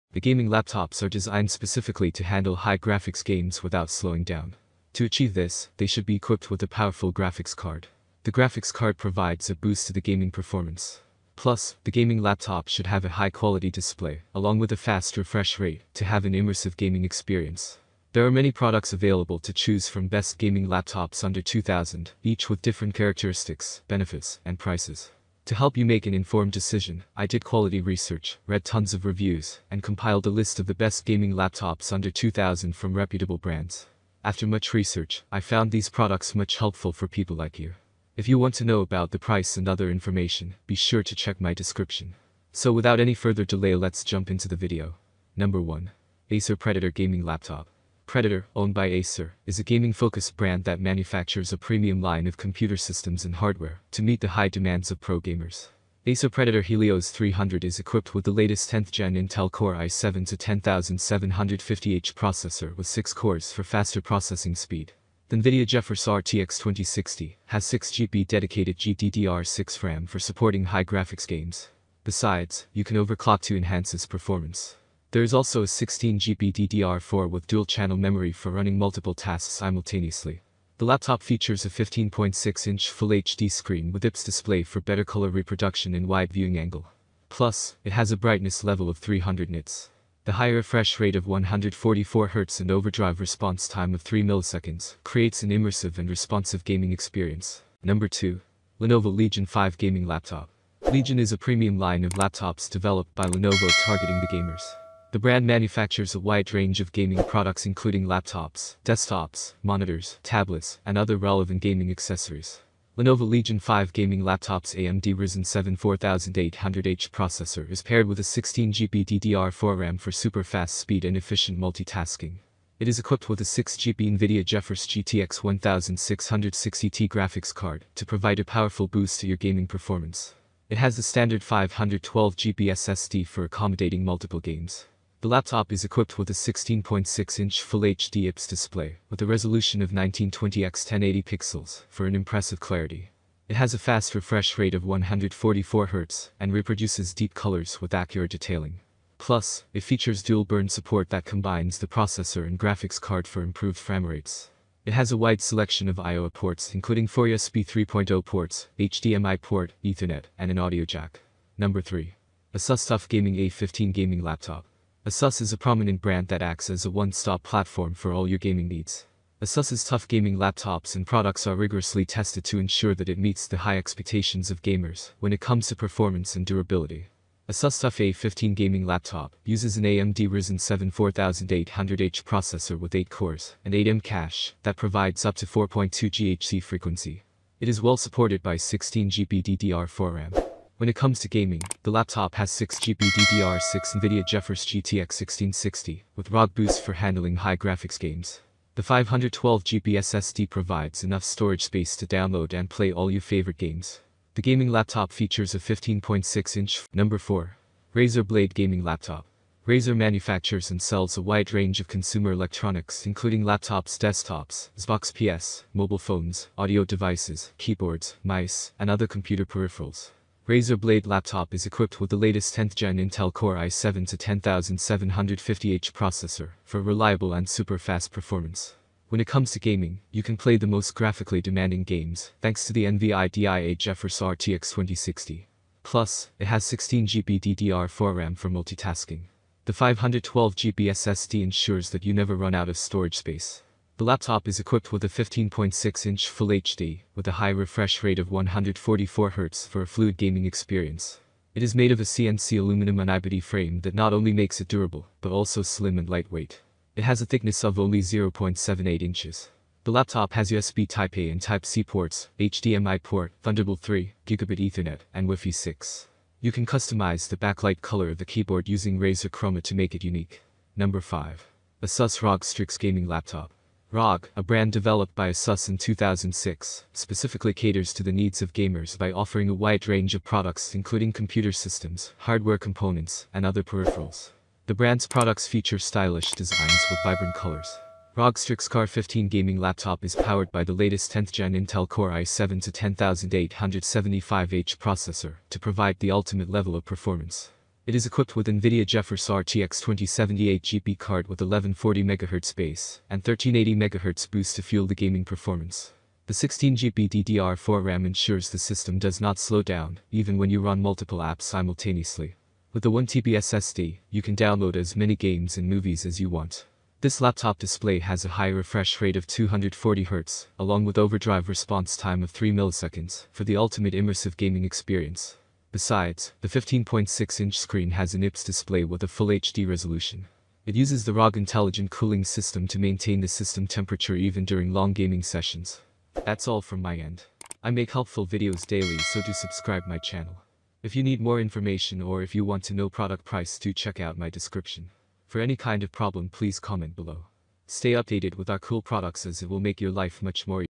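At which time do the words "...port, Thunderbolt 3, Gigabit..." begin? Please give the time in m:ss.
4:23.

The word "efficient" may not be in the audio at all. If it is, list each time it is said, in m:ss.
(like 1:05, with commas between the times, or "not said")
2:01.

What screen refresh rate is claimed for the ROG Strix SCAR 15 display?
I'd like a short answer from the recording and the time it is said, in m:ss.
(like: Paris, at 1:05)
240Hz, at 5:19.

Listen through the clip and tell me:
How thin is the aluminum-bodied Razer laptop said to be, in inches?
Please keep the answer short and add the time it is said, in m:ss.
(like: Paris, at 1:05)
0.78 inches, at 4:17.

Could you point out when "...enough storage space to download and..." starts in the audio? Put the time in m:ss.
3:21.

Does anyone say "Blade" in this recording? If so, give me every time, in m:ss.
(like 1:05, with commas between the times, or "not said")
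3:28, 3:40.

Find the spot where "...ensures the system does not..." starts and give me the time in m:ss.
5:08.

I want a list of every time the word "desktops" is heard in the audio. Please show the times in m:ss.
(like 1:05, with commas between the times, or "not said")
1:48, 3:33.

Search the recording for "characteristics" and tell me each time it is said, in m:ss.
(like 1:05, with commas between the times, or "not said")
0:22.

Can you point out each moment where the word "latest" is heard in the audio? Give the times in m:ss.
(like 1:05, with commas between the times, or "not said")
0:58, 3:42, 4:50.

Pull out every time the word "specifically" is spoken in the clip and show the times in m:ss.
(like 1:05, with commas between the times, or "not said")
0:01, 4:36.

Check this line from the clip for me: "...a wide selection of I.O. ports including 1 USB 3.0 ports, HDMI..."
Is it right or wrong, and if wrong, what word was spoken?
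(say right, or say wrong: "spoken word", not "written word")
wrong: "4", not "1".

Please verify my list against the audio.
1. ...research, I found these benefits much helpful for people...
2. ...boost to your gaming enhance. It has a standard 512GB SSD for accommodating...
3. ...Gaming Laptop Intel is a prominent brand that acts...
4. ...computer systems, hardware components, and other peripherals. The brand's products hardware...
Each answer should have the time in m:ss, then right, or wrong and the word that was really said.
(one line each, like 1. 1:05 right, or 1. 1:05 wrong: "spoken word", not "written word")
1. 0:34 wrong: "products", not "benefits"
2. 2:08 wrong: "performance", not "enhance"
3. 2:43 wrong: "Asus", not "Intel"
4. 4:41 wrong: "feature", not "hardware".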